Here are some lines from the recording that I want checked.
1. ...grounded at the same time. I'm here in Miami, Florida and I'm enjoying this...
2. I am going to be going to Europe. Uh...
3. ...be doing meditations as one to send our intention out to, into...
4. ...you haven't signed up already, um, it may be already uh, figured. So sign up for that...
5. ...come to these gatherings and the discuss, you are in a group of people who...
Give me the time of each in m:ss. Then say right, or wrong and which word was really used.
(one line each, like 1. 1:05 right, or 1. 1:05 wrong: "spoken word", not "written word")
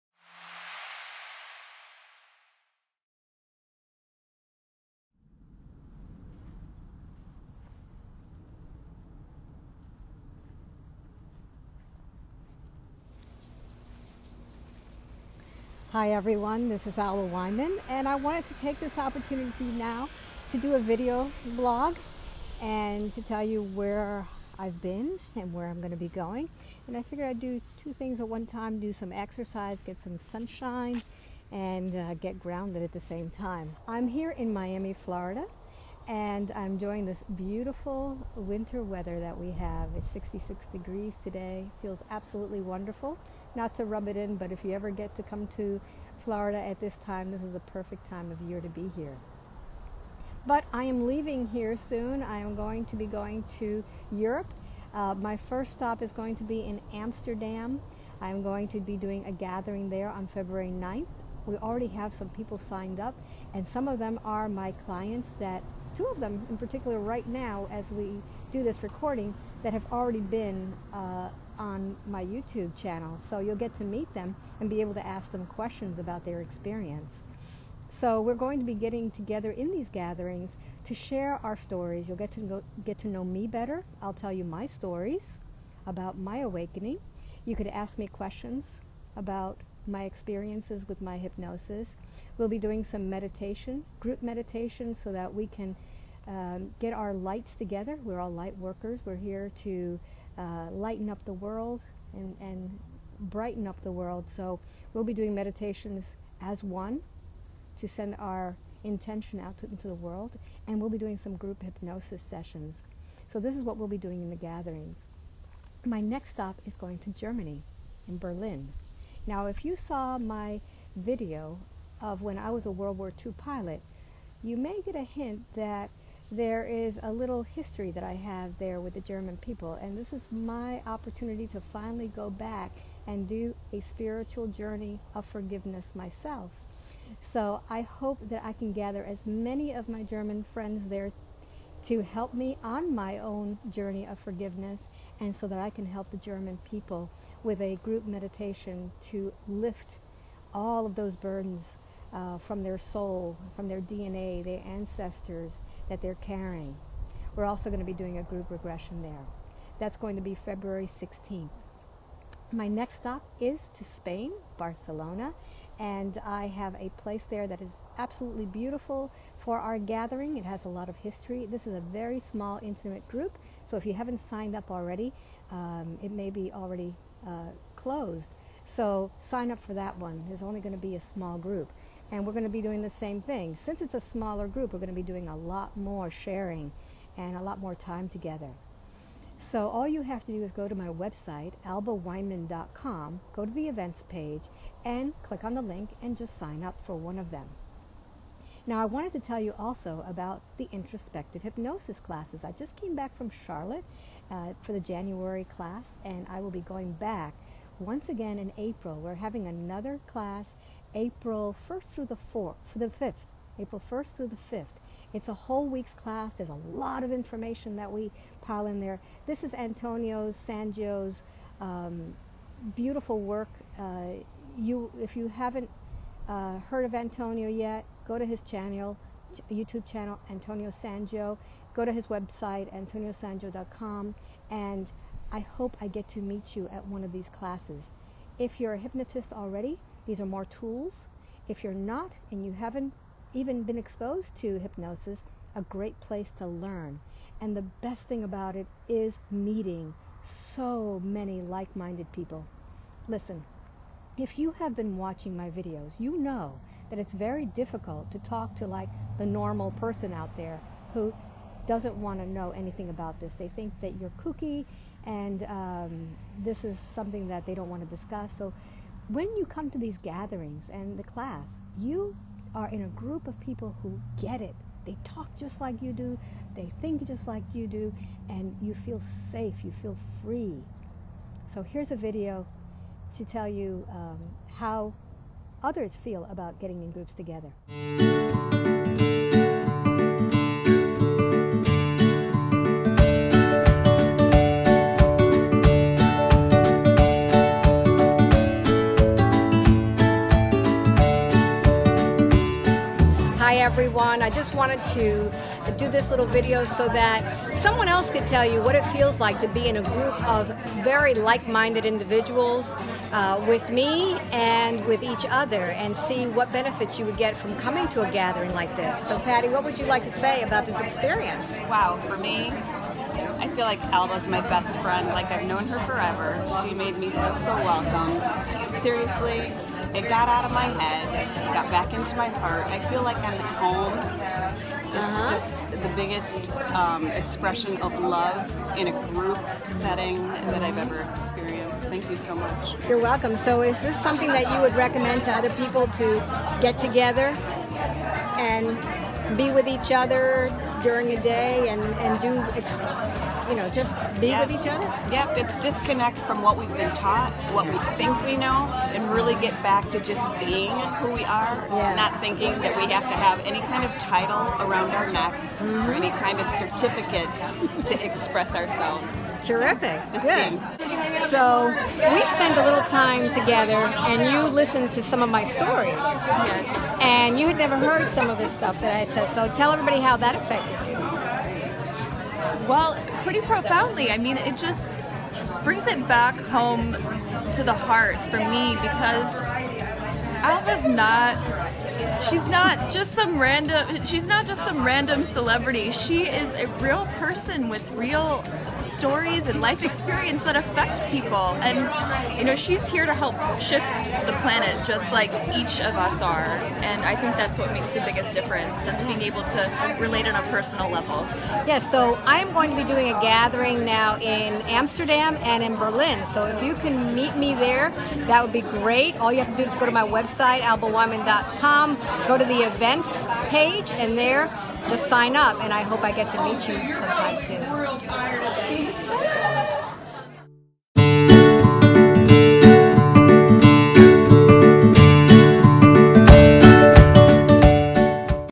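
1. 0:32 right
2. 0:52 right
3. 1:45 right
4. 2:53 wrong: "closed", not "figured"
5. 4:29 wrong: "class", not "discuss".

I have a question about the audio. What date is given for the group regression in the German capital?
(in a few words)
February 16th.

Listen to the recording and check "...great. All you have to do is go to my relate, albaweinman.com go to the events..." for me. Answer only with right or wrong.
wrong.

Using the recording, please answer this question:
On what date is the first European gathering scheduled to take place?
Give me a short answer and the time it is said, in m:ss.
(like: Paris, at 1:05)
February 9th, at 1:00.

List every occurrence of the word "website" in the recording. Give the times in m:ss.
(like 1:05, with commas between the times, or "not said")
3:10, 3:52, 7:00.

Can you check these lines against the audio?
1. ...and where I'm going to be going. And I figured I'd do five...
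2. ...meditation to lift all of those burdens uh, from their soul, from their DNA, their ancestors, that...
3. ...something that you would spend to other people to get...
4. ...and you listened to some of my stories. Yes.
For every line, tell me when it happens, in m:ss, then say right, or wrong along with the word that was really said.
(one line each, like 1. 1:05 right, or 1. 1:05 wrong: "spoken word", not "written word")
1. 0:25 wrong: "two", not "five"
2. 2:28 right
3. 5:44 wrong: "recommend", not "spend"
4. 6:14 right.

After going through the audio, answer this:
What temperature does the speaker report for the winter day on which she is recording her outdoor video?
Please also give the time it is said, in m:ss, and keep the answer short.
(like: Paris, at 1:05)
66 degrees, at 0:40.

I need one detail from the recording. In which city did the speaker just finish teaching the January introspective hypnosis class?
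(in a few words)
Charlotte.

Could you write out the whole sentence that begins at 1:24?
I'll tell you my stories about my awakening.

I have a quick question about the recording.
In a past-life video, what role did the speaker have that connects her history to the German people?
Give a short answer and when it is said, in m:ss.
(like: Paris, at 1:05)
World War II pilot, at 2:02.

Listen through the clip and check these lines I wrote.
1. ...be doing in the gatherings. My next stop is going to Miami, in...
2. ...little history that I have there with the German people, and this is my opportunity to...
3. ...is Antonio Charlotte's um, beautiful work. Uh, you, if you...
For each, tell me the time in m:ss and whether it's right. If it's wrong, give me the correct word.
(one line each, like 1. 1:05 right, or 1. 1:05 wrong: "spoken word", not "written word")
1. 1:53 wrong: "Germany", not "Miami"
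2. 2:07 right
3. 3:39 wrong: "Sangio", not "Charlotte".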